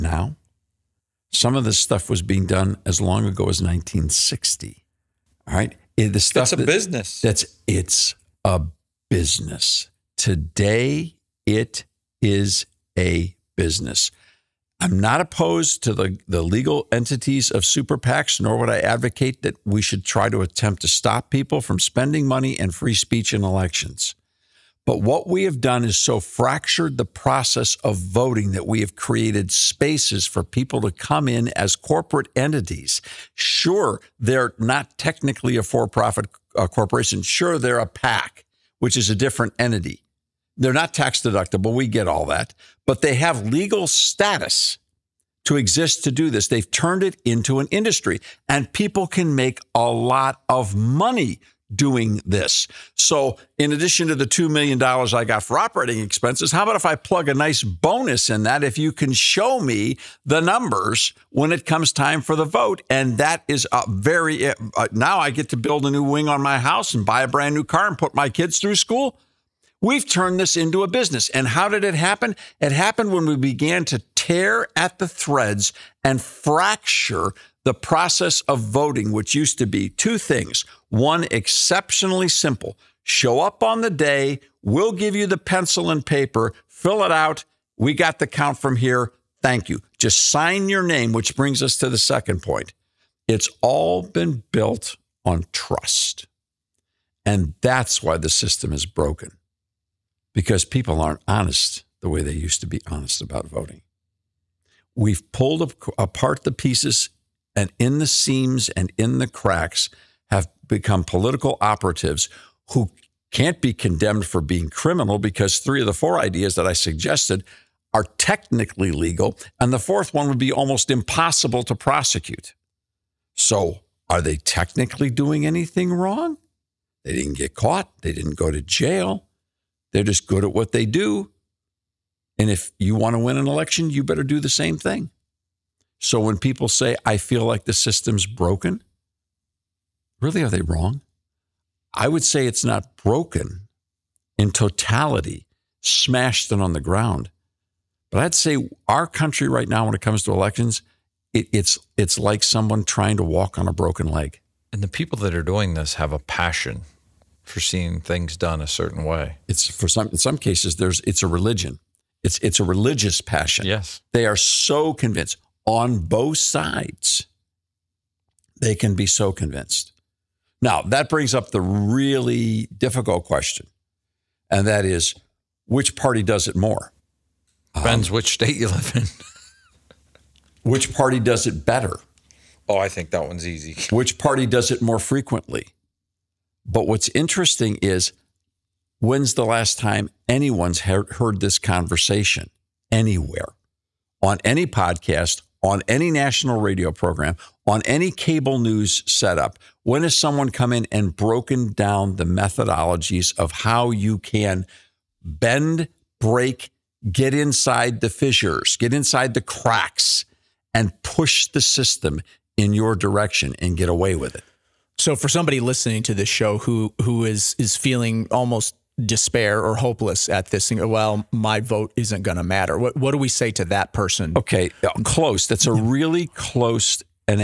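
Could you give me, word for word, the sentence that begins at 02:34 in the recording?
And the people that are doing this have a passion for seeing things done a certain way.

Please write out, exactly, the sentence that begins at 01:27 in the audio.
We got the count from here.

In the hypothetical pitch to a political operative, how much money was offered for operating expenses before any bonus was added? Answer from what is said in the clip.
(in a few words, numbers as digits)
$2 million.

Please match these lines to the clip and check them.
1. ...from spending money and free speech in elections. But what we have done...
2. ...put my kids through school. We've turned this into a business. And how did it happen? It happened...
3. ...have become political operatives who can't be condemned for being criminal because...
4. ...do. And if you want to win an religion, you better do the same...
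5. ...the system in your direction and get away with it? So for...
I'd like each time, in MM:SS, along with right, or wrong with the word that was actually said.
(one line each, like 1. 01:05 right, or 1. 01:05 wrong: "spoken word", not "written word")
1. 00:21 right
2. 01:07 right
3. 01:50 right
4. 02:10 wrong: "election", not "religion"
5. 03:31 right.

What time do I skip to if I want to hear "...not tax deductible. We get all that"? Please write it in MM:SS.
00:40.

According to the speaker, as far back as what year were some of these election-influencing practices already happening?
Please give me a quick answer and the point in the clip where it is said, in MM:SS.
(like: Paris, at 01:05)
1960, at 00:03.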